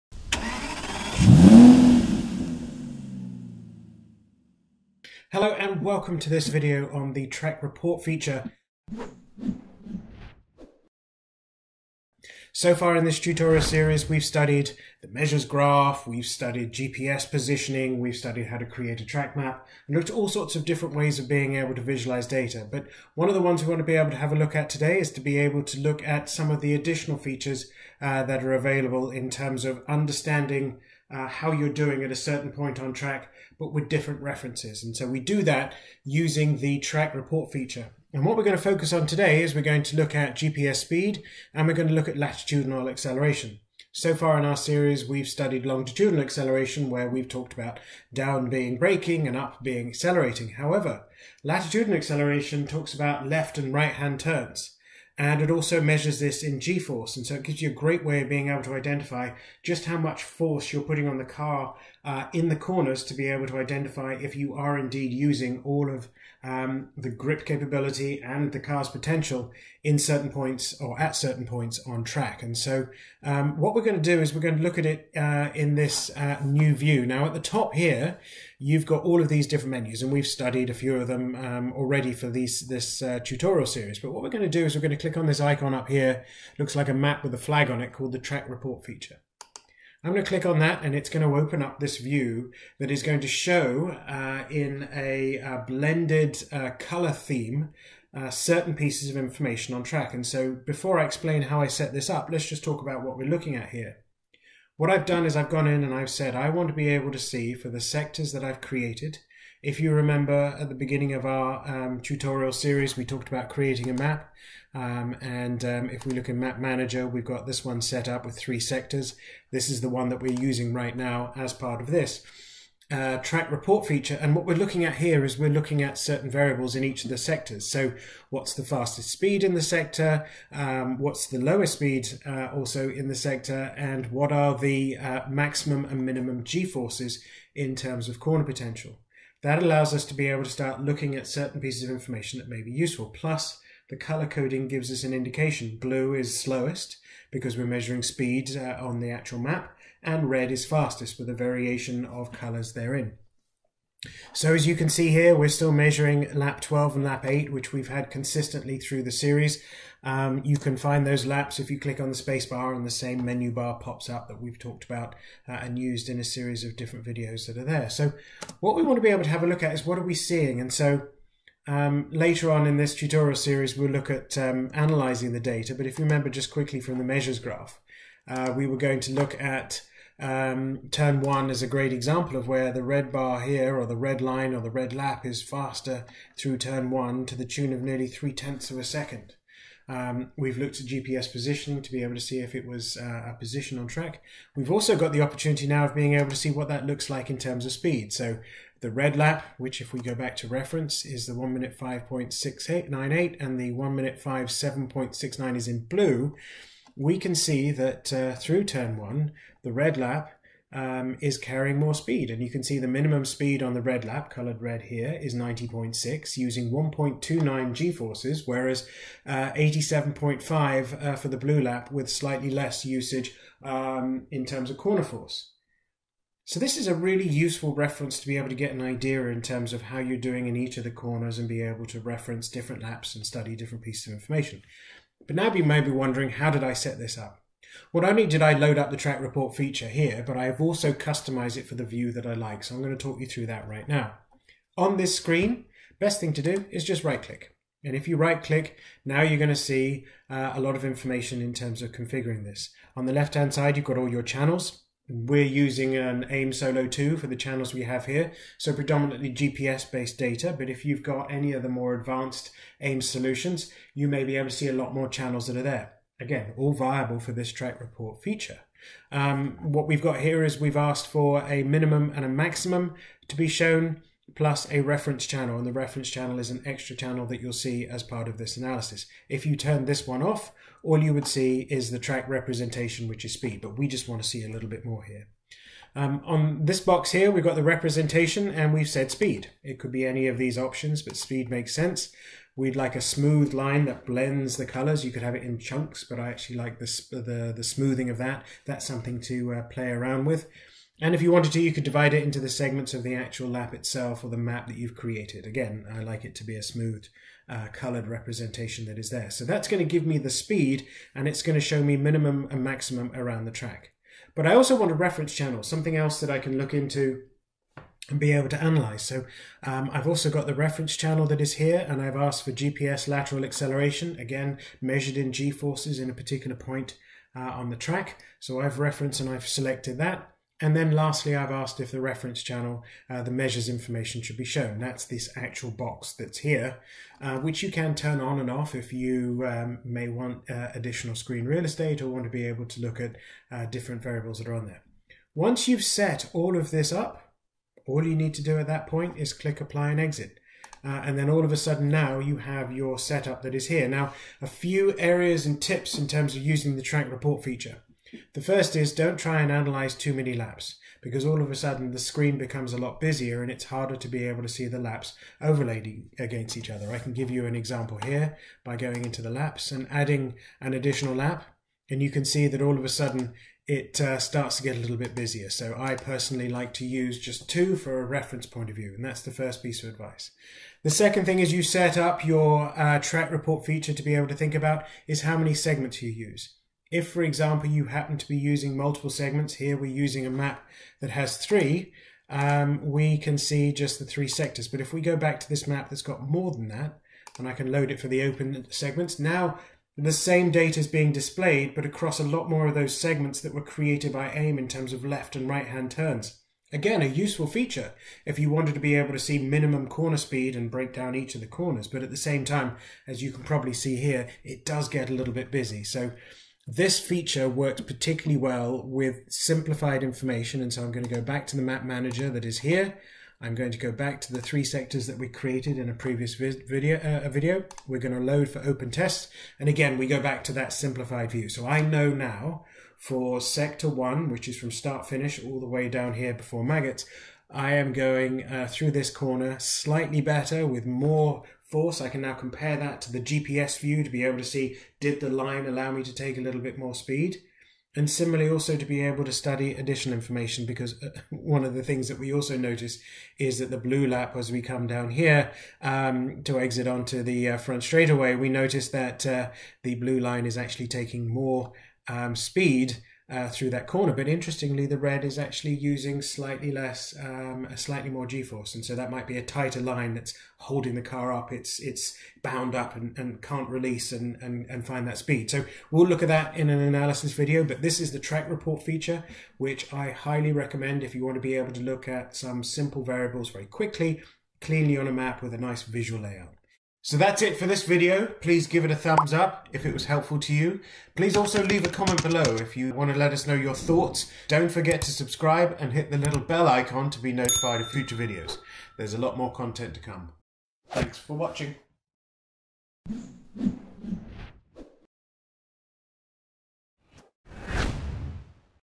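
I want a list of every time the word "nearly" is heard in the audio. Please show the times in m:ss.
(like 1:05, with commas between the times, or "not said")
3:07.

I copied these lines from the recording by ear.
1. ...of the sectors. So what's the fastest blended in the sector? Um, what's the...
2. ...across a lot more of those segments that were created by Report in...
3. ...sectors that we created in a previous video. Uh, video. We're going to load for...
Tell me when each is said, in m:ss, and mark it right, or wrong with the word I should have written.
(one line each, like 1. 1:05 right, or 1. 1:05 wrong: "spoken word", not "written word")
1. 2:07 wrong: "speed", not "blended"
2. 6:41 wrong: "AIM", not "Report"
3. 7:04 right.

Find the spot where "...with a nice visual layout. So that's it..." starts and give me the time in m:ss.
8:05.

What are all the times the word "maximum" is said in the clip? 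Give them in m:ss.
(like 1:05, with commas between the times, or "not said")
2:15, 4:32, 5:12.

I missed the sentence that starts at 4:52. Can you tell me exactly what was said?
We'd like a smooth line that blends the colors.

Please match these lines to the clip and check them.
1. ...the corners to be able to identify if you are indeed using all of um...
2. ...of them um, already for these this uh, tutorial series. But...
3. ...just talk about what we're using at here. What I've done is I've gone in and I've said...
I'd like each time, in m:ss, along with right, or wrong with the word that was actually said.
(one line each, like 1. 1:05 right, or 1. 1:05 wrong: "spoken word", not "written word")
1. 1:02 right
2. 1:20 right
3. 1:42 wrong: "looking", not "using".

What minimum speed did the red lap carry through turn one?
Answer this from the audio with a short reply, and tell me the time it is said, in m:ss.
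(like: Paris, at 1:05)
90.6, at 3:35.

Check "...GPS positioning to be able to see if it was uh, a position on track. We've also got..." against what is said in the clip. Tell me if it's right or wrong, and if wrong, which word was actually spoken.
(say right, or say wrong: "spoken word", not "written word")
right.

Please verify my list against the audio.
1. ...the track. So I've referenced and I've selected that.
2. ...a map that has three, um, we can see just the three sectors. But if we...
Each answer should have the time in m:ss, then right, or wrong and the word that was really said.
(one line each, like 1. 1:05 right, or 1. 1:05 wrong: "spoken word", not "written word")
1. 5:27 right
2. 6:30 right.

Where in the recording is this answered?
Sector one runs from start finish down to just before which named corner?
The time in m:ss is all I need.
7:16.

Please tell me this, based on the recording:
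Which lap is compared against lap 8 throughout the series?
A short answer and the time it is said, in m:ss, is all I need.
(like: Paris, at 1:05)
12, at 2:36.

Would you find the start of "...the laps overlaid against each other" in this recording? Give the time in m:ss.
6:04.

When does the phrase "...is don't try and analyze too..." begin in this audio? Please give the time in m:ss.
5:58.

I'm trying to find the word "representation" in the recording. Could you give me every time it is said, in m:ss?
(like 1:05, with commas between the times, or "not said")
4:42, 4:47, 5:08.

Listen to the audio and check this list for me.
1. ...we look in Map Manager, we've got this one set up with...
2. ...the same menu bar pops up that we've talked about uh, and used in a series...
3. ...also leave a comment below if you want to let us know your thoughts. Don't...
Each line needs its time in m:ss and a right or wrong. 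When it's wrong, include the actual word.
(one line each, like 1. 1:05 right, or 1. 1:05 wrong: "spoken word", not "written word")
1. 1:56 right
2. 2:42 right
3. 8:11 right.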